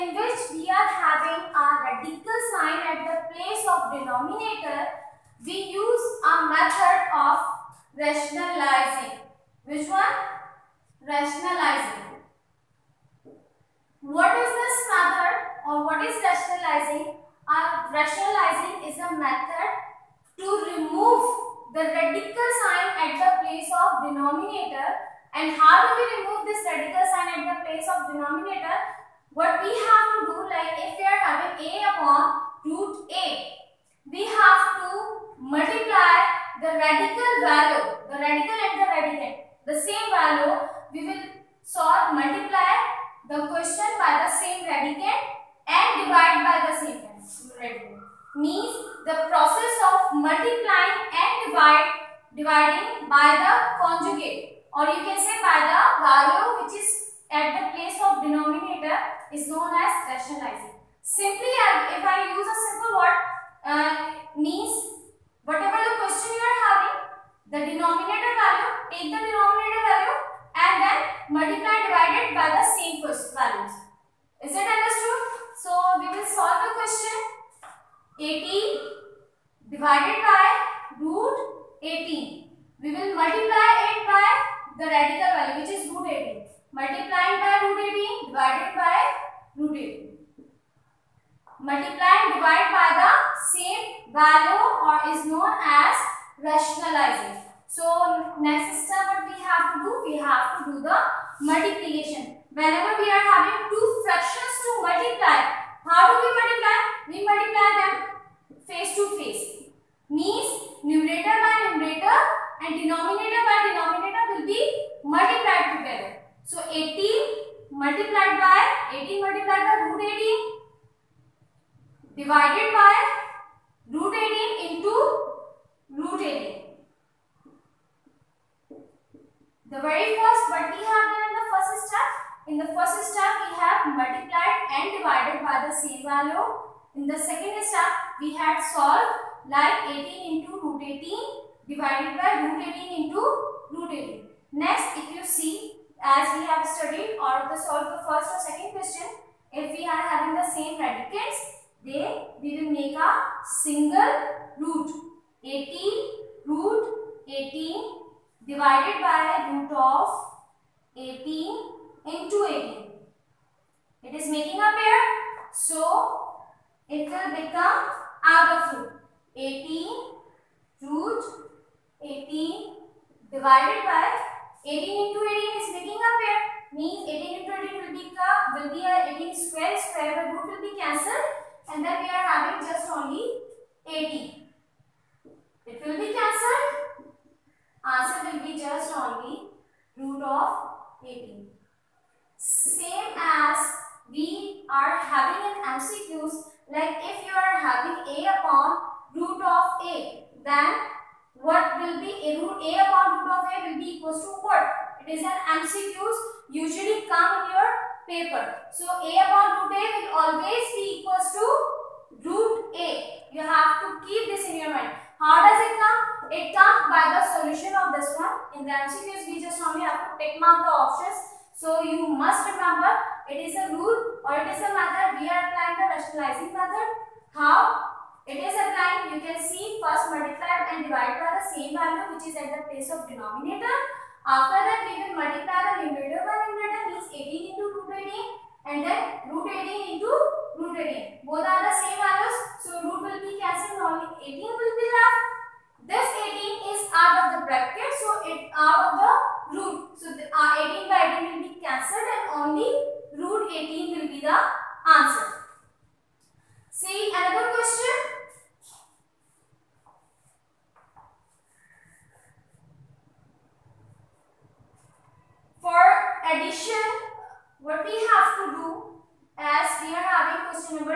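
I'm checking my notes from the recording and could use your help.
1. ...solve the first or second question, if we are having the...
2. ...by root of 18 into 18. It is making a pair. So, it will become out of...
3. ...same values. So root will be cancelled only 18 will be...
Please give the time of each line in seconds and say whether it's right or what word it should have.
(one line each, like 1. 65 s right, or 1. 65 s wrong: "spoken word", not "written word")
1. 147 s right
2. 158 s right
3. 241 s right.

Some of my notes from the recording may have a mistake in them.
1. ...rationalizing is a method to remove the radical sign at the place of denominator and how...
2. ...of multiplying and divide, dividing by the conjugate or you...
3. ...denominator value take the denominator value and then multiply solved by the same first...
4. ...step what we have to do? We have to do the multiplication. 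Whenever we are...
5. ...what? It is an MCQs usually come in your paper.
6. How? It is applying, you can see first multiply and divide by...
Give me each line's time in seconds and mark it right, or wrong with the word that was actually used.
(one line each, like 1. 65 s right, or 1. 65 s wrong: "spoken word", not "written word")
1. 17 s right
2. 49 s right
3. 67 s wrong: "divided", not "solved"
4. 98 s right
5. 204 s right
6. 227 s right.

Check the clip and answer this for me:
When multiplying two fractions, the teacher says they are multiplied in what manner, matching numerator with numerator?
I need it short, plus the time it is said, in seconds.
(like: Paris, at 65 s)
Face to face, at 108 s.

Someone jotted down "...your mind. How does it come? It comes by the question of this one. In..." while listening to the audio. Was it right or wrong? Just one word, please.
wrong.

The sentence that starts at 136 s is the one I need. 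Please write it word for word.
In the second step, we had solved like 18 into root 18 divided by root 18 into root 18.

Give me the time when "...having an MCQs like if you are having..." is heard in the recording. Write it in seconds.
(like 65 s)
194 s.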